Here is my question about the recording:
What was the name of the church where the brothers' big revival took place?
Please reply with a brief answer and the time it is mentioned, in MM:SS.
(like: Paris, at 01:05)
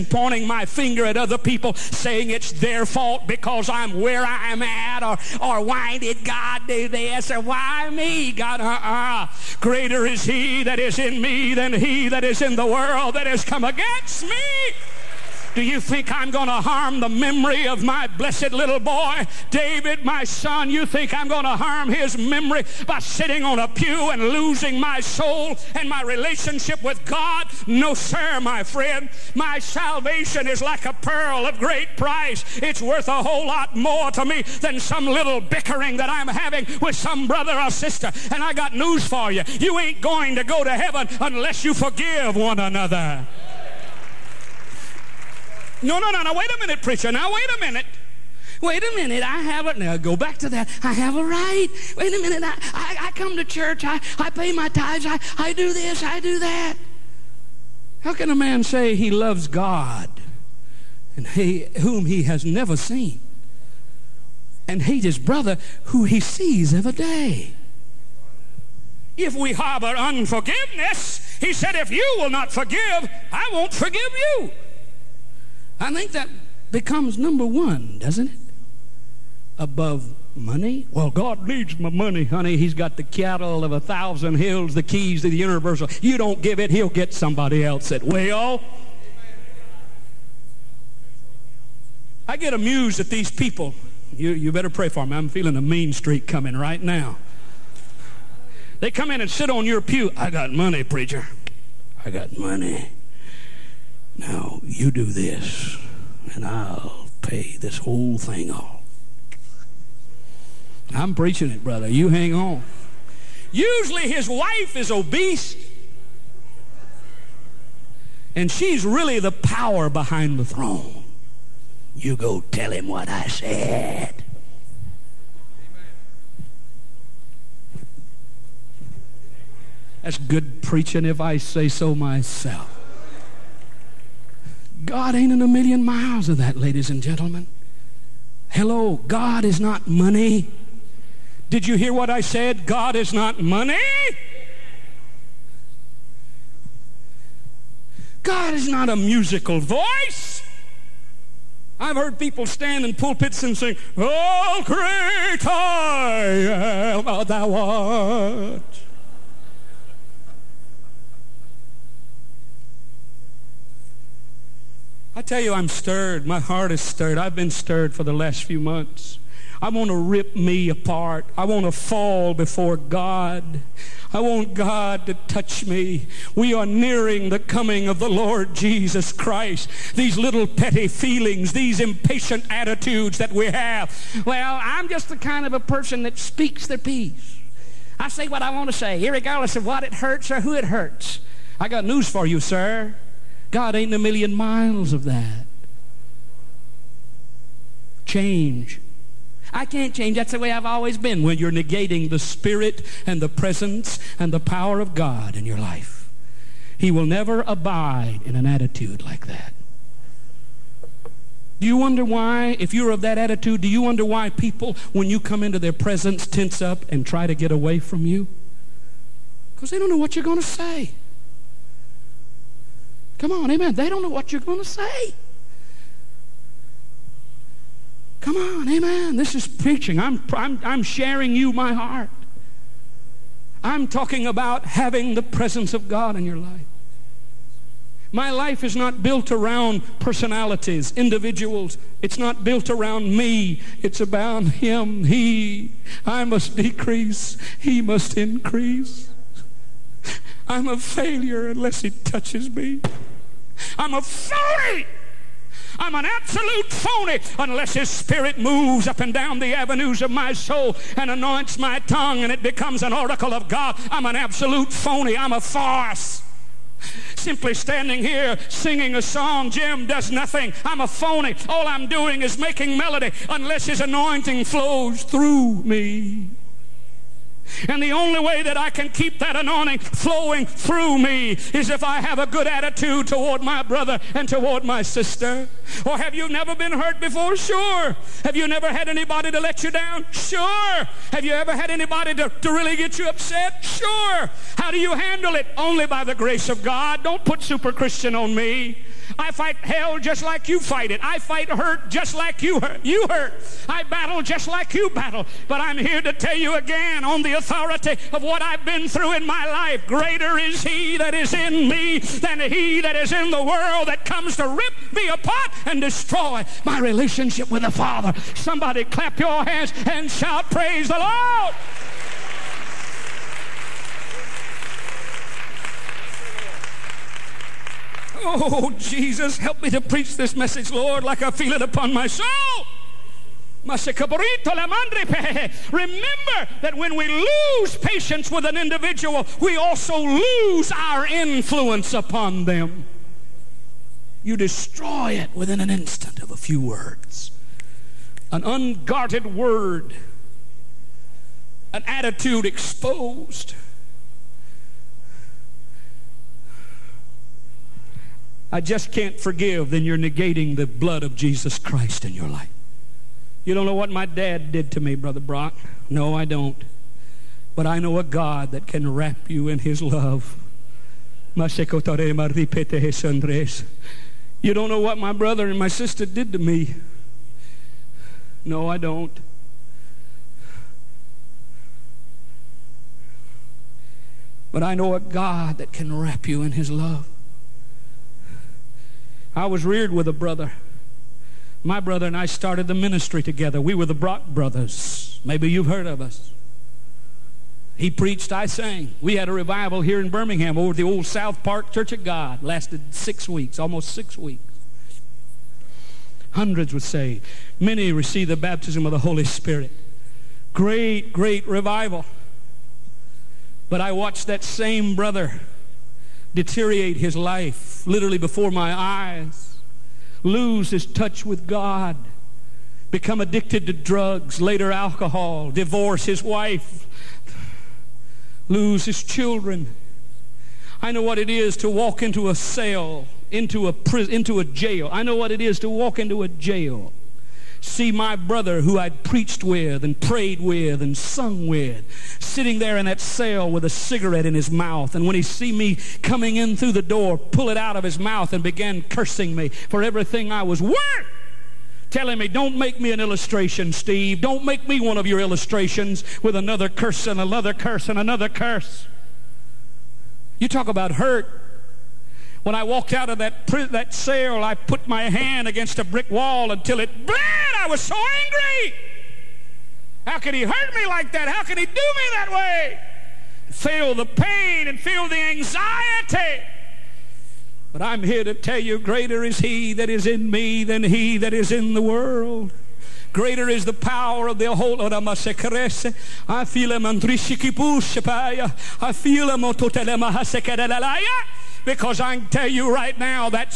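South Park Church of God, at 06:41.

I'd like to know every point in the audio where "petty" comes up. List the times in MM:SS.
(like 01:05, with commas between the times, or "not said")
03:00.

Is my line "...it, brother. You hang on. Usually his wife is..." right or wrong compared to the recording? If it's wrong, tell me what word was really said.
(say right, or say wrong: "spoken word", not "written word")
right.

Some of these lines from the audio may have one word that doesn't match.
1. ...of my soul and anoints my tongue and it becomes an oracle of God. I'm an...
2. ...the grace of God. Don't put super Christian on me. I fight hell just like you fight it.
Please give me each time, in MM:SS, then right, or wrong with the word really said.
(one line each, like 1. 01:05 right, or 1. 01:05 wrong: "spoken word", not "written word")
1. 04:20 right
2. 04:56 right.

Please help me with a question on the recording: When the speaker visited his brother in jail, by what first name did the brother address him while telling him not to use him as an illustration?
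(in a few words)
Steve.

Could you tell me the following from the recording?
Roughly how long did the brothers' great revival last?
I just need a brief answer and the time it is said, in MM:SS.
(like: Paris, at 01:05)
Almost 6 weeks, at 06:43.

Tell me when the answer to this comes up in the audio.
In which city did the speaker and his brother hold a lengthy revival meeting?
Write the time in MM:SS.
06:40.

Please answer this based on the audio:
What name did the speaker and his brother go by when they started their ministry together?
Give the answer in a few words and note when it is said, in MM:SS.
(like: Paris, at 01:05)
The Brock brothers, at 06:33.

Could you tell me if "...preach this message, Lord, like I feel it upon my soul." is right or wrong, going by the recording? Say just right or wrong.
right.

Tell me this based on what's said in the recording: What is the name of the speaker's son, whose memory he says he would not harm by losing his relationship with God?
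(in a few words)
David.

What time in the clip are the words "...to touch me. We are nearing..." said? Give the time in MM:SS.
02:55.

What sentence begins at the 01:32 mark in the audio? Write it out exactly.
I get amused at these people.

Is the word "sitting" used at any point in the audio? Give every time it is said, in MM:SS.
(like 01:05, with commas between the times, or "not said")
00:22, 07:22.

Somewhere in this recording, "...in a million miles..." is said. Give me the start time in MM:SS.
02:15.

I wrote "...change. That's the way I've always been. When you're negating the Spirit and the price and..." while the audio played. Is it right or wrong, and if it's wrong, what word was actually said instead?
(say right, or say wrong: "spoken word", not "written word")
wrong: "presence", not "price".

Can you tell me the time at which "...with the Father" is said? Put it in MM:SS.
05:17.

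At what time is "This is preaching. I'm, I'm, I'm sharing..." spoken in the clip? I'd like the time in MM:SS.
03:49.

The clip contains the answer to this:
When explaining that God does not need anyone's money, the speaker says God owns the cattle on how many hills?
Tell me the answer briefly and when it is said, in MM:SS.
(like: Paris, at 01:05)
1000, at 01:23.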